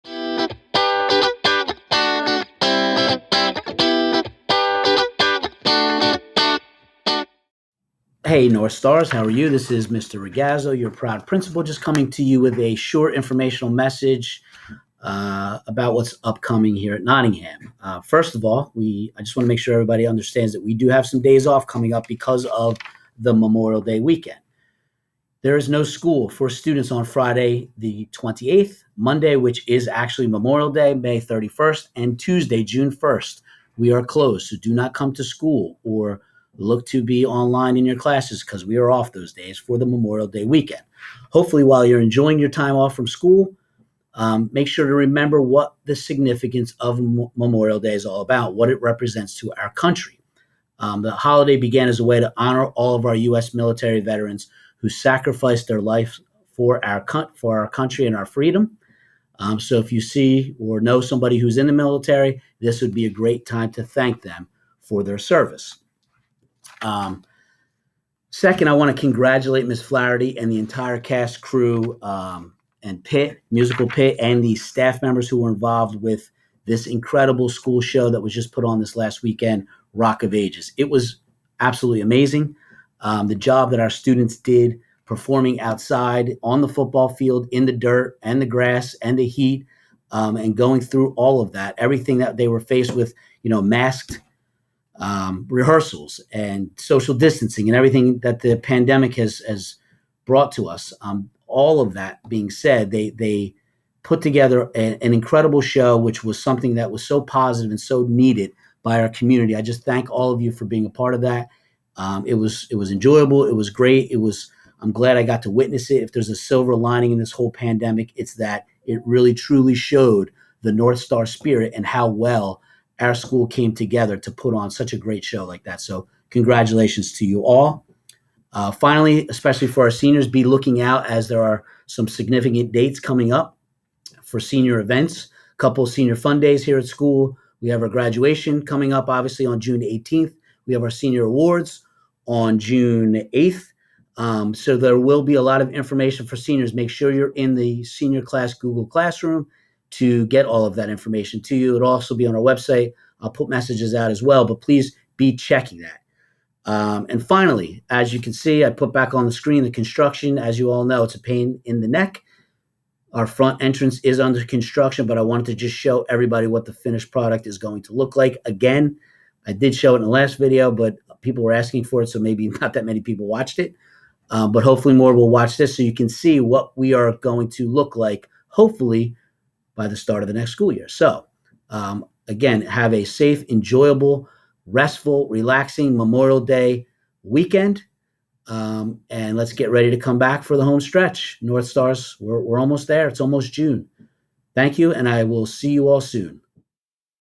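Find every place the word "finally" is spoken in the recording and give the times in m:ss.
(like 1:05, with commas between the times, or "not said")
2:08, 2:37.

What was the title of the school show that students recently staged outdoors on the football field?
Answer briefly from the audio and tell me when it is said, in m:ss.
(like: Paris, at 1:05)
Rock of Ages, at 1:19.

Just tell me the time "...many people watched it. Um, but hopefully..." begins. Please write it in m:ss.
2:52.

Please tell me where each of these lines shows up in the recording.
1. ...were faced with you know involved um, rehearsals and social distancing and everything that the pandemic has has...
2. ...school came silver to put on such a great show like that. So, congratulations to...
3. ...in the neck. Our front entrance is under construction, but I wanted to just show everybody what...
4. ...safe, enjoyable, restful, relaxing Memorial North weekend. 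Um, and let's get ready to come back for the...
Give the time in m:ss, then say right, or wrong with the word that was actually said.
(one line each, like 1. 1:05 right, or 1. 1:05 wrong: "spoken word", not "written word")
1. 1:32 wrong: "masked", not "involved"
2. 2:03 wrong: "together", not "silver"
3. 2:41 right
4. 3:03 wrong: "Day", not "North".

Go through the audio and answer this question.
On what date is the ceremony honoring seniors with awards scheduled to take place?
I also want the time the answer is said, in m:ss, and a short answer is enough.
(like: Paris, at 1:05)
June 8th, at 2:22.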